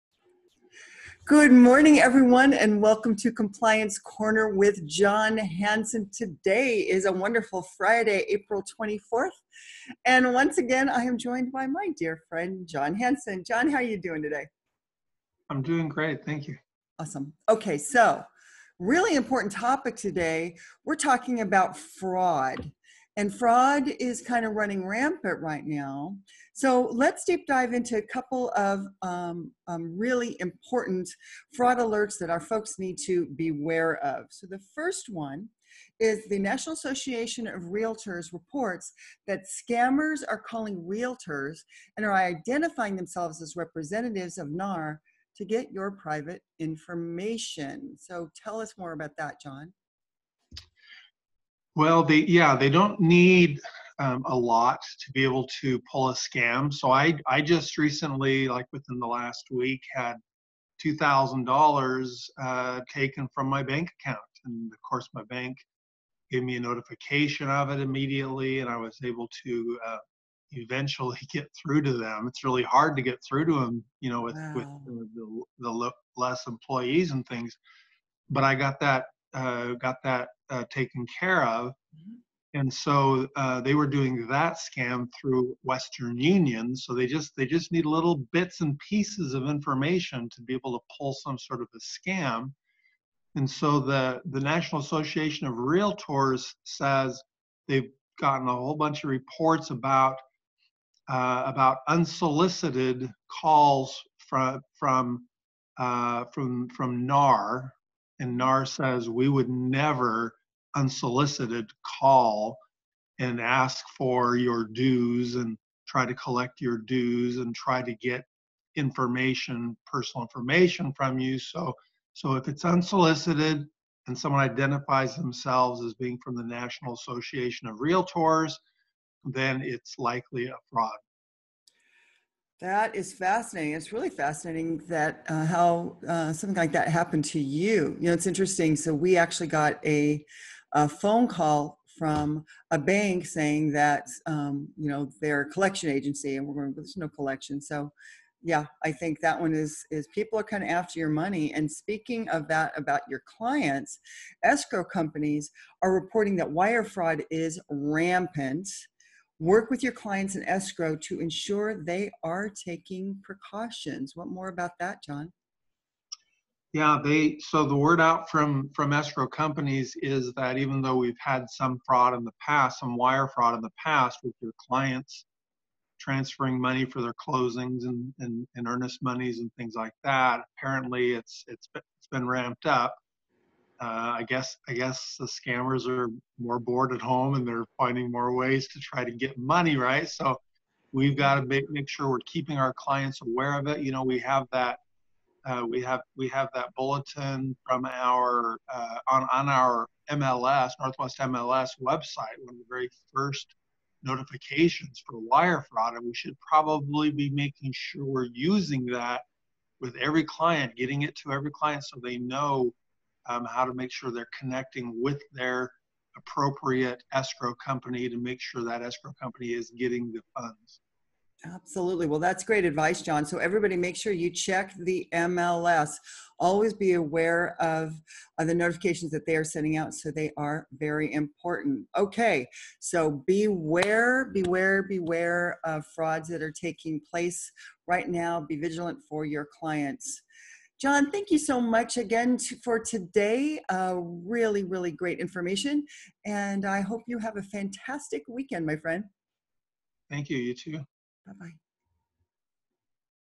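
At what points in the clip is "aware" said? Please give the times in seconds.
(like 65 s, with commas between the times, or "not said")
193 s, 226 s.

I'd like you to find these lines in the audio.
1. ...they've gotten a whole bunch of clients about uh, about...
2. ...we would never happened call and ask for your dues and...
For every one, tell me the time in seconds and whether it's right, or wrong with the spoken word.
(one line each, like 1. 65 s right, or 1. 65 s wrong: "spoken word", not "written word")
1. 97 s wrong: "reports", not "clients"
2. 109 s wrong: "unsolicited", not "happened".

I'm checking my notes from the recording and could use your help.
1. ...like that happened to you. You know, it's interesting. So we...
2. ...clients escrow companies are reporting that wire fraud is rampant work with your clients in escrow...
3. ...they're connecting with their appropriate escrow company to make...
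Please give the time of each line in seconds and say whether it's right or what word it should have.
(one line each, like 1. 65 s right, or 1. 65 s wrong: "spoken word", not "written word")
1. 136 s right
2. 153 s right
3. 214 s right.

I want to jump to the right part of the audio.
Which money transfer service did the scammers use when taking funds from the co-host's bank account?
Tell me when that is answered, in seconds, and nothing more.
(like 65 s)
85 s.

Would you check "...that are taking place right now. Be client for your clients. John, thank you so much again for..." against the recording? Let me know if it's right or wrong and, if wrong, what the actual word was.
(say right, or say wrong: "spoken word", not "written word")
wrong: "vigilant", not "client".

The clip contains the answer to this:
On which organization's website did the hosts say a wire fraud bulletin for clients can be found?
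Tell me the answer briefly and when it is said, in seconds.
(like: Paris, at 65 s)
Northwest MLS, at 200 s.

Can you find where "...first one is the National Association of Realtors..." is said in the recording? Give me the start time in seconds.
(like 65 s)
34 s.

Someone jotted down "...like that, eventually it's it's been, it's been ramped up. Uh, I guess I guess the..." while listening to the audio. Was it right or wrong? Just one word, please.
wrong.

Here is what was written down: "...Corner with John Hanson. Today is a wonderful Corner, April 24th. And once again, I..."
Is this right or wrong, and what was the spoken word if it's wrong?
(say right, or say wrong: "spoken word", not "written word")
wrong: "Friday", not "Corner".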